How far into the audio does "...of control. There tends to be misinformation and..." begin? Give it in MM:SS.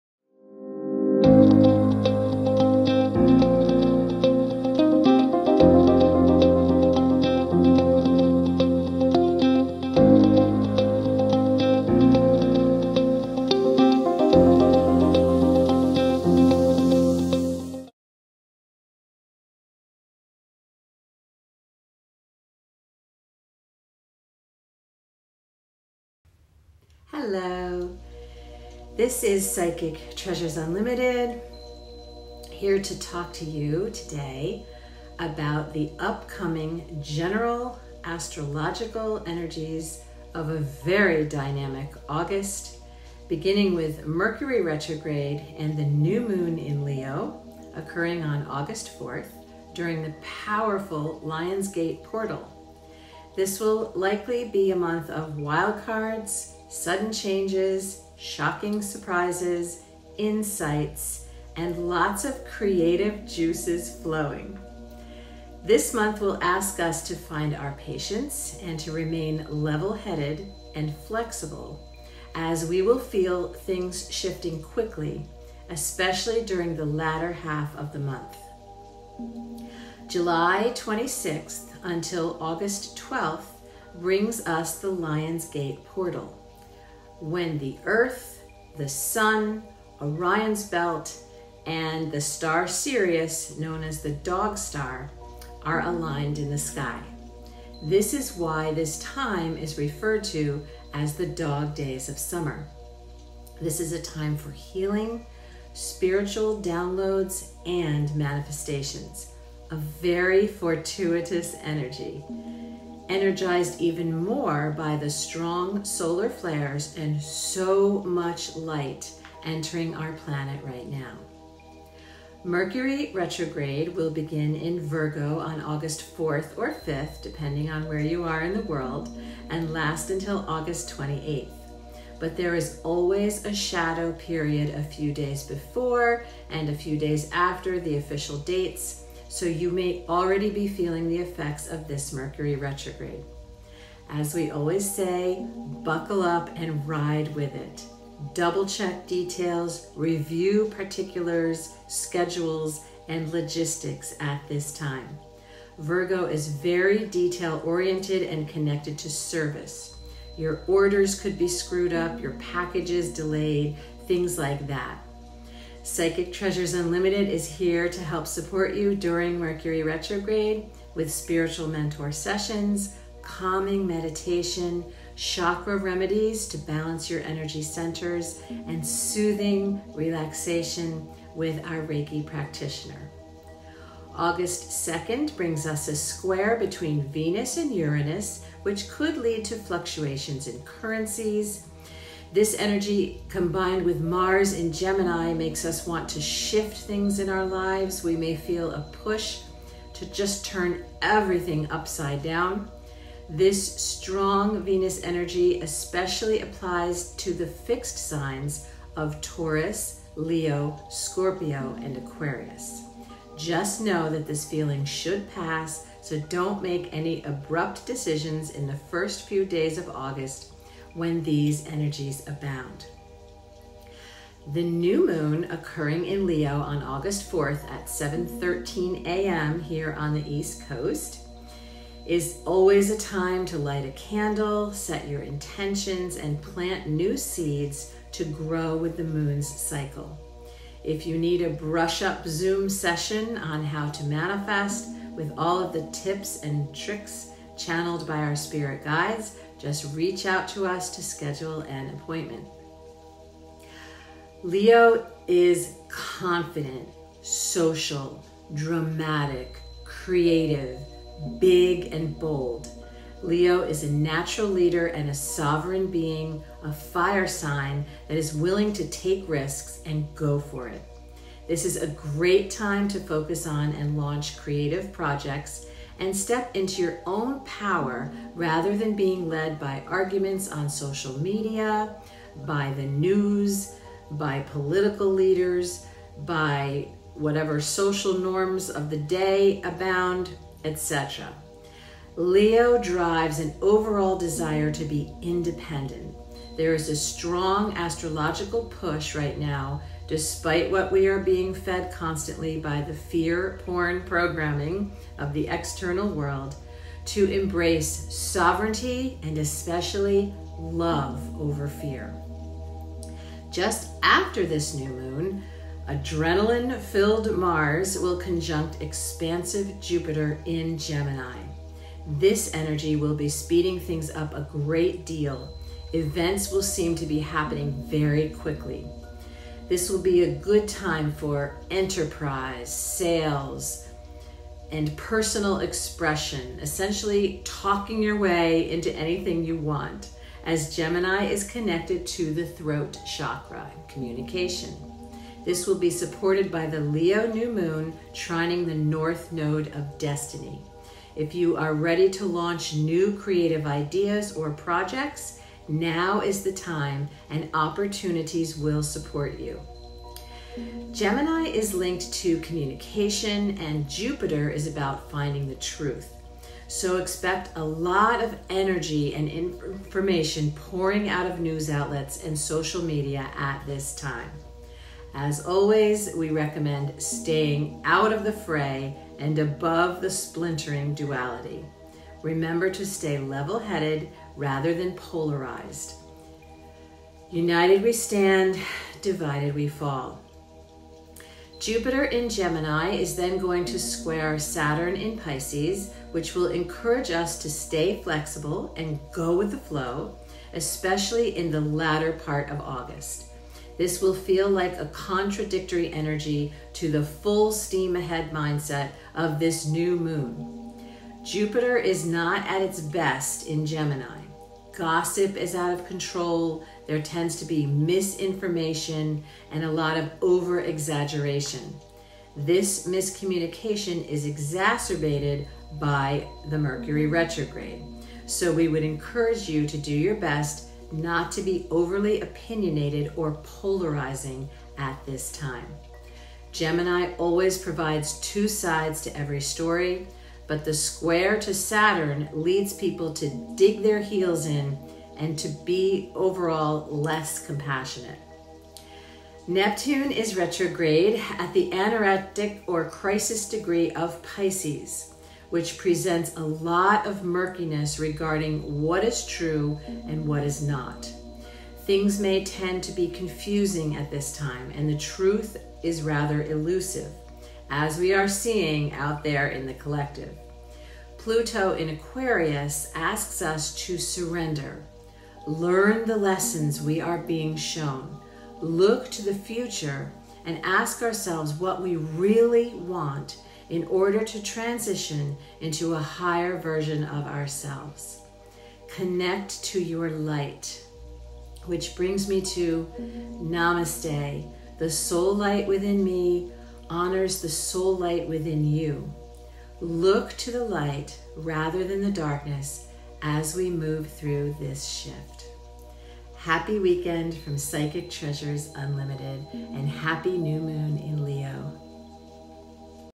06:55.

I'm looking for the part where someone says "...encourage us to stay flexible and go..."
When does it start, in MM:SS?
06:36.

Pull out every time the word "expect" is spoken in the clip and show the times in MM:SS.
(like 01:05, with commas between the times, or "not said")
06:06.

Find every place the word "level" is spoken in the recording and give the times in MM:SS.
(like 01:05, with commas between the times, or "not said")
01:09, 06:23.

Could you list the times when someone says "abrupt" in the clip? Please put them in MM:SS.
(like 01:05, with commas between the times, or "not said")
03:37.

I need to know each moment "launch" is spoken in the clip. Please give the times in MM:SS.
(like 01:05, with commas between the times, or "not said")
04:33, 05:52.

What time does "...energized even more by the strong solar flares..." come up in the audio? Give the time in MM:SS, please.
01:53.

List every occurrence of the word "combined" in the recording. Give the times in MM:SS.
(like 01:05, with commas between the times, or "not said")
03:13.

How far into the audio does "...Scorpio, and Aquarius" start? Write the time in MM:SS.
03:30.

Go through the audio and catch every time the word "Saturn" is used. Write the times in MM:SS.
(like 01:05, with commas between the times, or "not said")
06:34, 07:21.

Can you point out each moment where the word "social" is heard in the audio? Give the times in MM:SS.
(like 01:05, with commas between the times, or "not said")
04:17, 04:40, 04:47, 06:12.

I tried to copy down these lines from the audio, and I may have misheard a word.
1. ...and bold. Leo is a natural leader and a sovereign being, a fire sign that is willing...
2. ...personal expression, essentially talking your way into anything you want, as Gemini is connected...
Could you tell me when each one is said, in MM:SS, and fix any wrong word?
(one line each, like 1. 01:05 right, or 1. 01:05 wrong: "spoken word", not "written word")
1. 04:21 right
2. 05:34 right.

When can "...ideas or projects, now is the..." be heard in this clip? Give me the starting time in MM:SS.
05:53.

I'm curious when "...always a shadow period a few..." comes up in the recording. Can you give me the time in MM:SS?
02:12.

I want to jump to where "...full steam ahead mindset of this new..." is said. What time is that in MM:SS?
06:47.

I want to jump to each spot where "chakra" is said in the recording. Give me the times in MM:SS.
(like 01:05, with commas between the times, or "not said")
02:55, 05:43.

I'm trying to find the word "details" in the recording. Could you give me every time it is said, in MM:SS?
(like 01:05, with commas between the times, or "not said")
02:29, 02:37.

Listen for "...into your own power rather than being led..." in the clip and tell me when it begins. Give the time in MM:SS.
04:36.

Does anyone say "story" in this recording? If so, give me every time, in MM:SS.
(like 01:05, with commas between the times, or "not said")
07:19.